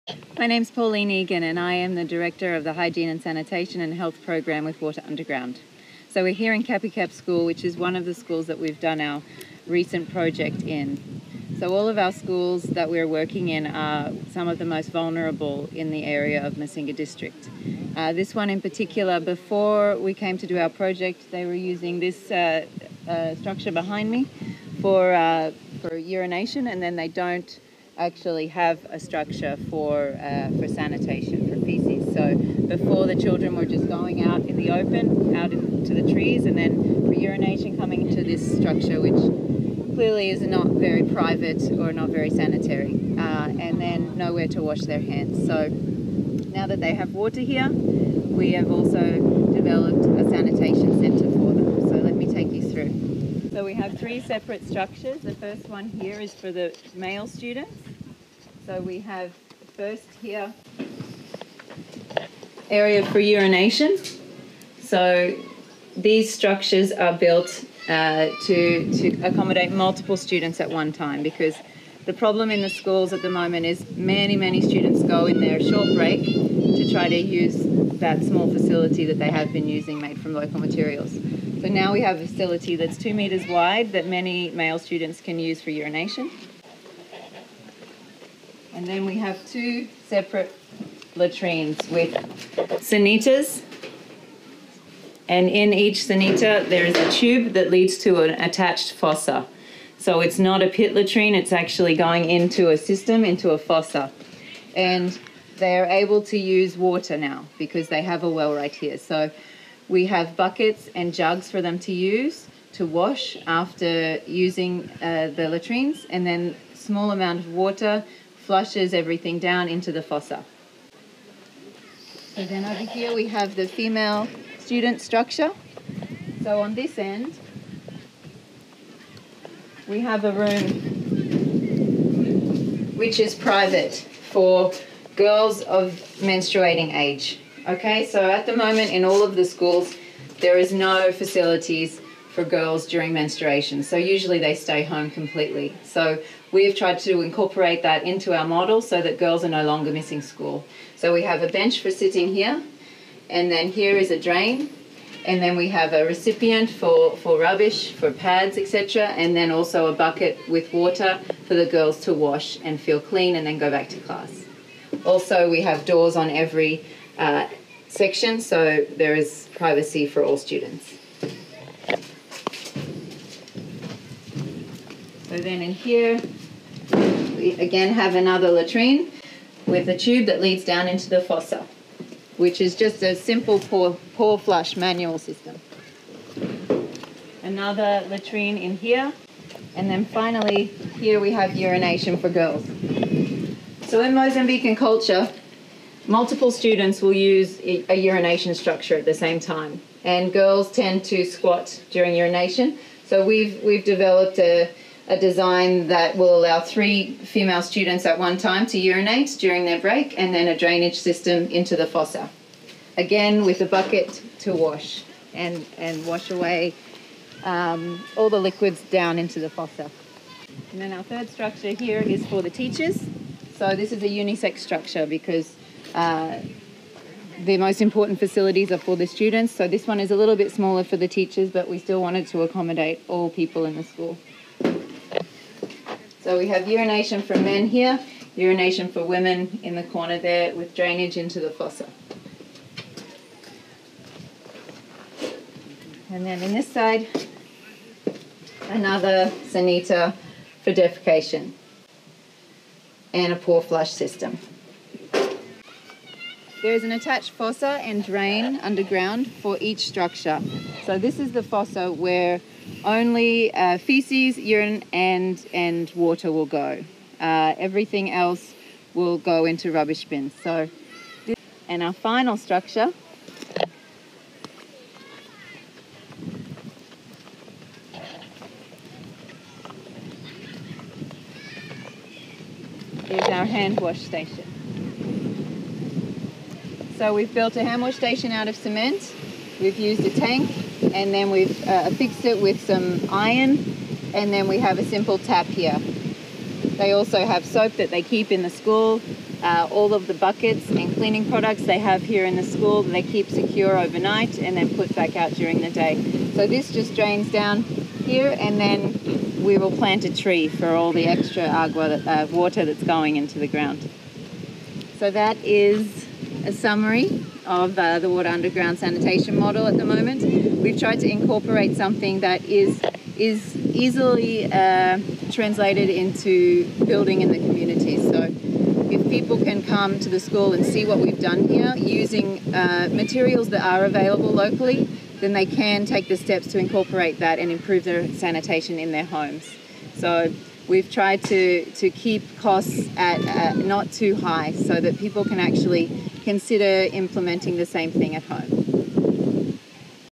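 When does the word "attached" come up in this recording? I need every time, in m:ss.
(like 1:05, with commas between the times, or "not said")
1:38, 4:16.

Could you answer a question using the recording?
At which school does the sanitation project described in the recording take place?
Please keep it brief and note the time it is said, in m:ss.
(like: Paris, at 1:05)
Capicap School, at 0:06.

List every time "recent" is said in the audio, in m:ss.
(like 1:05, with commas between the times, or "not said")
0:09.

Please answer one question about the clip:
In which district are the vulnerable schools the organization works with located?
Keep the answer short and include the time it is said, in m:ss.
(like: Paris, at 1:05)
Massinga District, at 0:16.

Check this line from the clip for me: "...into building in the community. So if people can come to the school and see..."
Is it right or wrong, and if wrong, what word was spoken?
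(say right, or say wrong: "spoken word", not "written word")
right.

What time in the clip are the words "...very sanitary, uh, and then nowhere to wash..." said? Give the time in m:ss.
0:42.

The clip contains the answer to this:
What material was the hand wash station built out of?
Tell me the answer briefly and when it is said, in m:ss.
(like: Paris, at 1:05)
cement, at 4:48.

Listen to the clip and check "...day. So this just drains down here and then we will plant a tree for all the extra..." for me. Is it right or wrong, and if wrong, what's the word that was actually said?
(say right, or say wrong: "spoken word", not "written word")
right.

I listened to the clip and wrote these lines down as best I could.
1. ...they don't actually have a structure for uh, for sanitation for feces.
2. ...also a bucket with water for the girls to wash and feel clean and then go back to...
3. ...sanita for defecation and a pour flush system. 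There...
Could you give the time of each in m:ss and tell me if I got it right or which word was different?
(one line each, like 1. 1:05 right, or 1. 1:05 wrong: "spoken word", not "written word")
1. 0:26 right
2. 2:39 right
3. 4:09 right.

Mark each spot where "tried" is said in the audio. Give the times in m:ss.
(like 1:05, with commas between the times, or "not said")
2:26, 5:20, 5:40.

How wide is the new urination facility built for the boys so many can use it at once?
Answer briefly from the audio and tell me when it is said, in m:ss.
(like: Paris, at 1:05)
2 metres, at 1:22.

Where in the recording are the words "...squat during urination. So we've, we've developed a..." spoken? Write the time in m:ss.
3:21.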